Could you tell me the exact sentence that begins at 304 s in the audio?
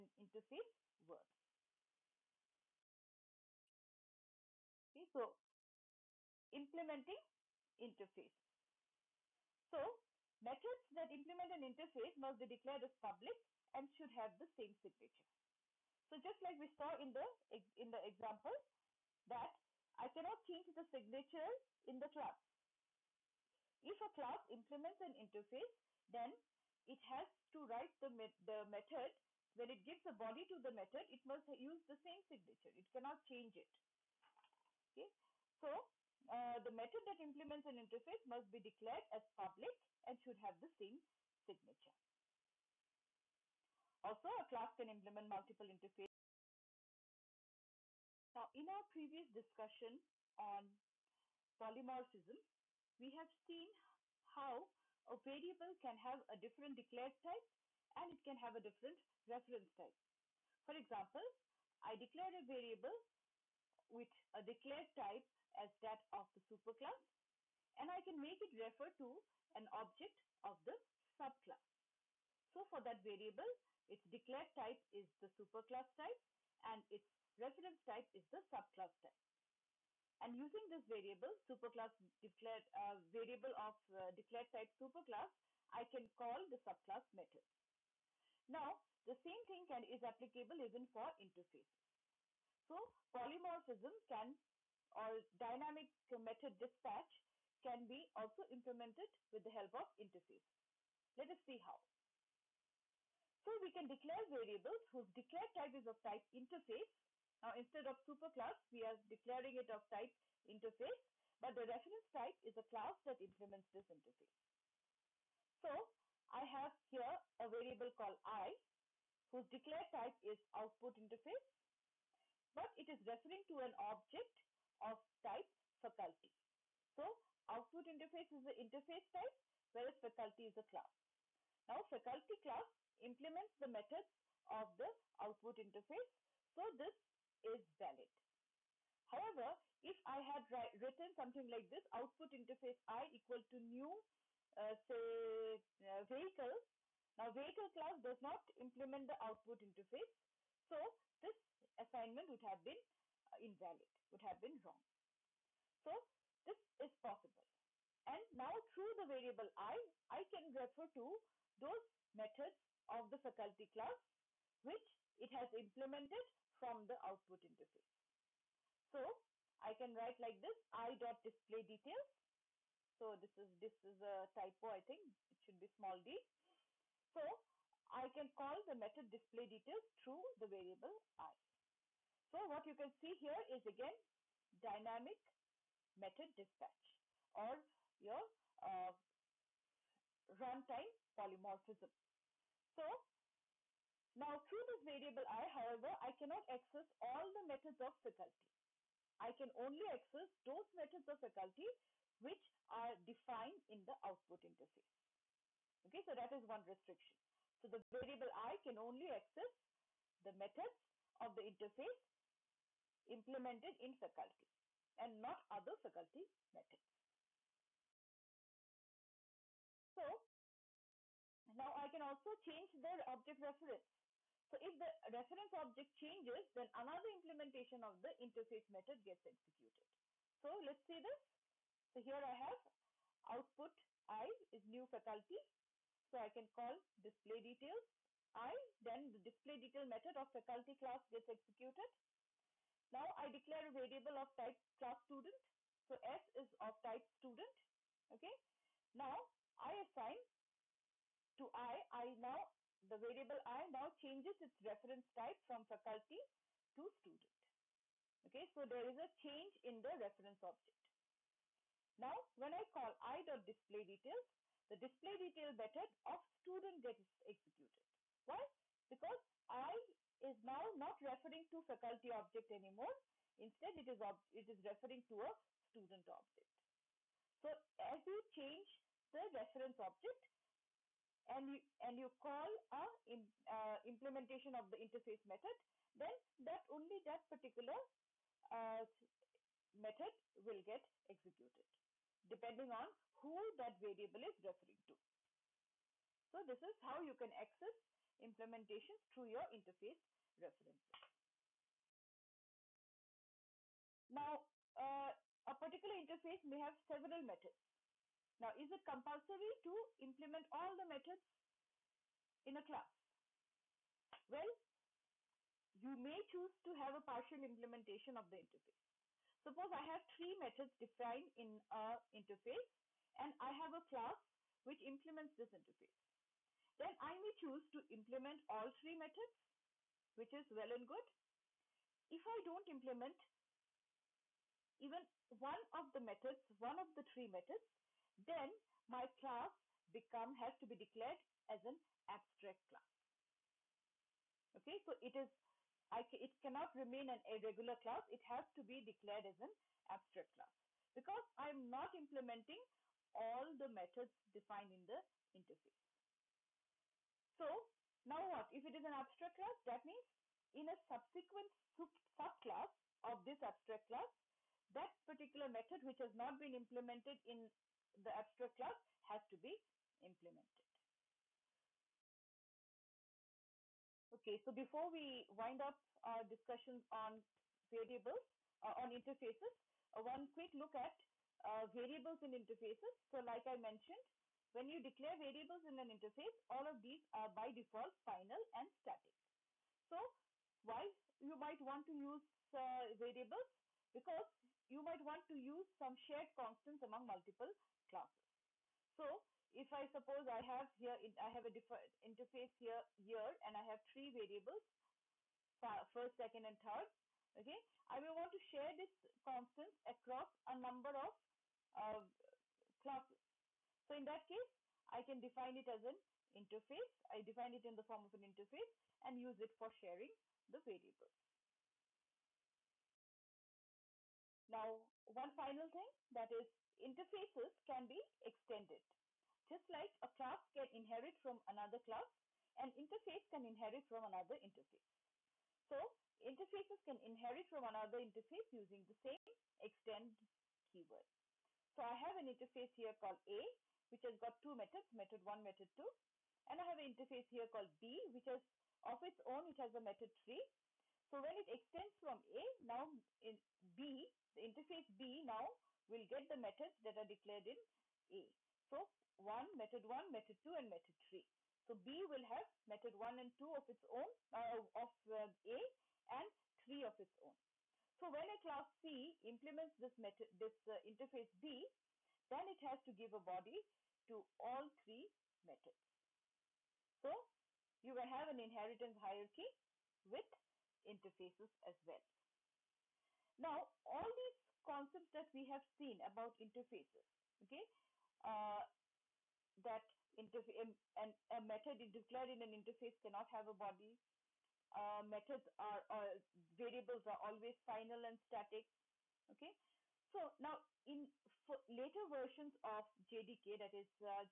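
Now, uh, a particular interface may have several methods.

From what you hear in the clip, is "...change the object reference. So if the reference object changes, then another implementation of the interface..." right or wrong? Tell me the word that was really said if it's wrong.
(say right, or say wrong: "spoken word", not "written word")
right.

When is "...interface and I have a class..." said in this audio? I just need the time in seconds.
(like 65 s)
322 s.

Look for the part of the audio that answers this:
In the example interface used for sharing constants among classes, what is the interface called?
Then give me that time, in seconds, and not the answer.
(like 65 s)
402 s.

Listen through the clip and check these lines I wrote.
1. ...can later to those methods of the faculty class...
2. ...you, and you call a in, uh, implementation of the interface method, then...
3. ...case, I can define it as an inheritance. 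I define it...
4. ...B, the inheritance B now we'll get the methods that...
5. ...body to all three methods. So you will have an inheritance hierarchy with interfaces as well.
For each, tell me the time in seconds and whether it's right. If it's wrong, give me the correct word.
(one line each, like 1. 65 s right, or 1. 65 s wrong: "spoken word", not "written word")
1. 160 s wrong: "refer", not "later"
2. 281 s right
3. 414 s wrong: "interface", not "inheritance"
4. 453 s wrong: "interface", not "inheritance"
5. 473 s right.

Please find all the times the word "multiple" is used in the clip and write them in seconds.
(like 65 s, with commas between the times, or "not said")
45 s, 397 s.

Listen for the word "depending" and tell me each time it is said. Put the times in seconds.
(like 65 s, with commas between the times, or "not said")
292 s.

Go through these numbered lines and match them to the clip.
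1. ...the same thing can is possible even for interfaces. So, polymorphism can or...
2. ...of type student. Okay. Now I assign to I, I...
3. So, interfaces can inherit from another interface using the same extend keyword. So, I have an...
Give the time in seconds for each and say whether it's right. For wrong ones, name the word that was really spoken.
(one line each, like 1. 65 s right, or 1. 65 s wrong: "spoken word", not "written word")
1. 89 s wrong: "applicable", not "possible"
2. 246 s right
3. 435 s right.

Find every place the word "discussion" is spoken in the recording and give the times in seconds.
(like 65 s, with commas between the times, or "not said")
49 s, 376 s.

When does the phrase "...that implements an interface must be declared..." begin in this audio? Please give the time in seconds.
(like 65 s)
37 s.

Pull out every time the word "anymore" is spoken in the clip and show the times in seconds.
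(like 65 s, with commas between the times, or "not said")
272 s.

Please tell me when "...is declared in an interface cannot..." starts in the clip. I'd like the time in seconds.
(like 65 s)
491 s.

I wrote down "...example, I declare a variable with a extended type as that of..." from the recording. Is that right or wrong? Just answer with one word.
wrong.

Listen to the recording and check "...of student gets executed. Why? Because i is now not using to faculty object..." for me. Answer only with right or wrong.
wrong.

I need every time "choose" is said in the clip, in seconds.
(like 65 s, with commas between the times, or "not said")
316 s, 327 s.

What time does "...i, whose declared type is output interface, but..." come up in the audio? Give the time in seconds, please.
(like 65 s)
118 s.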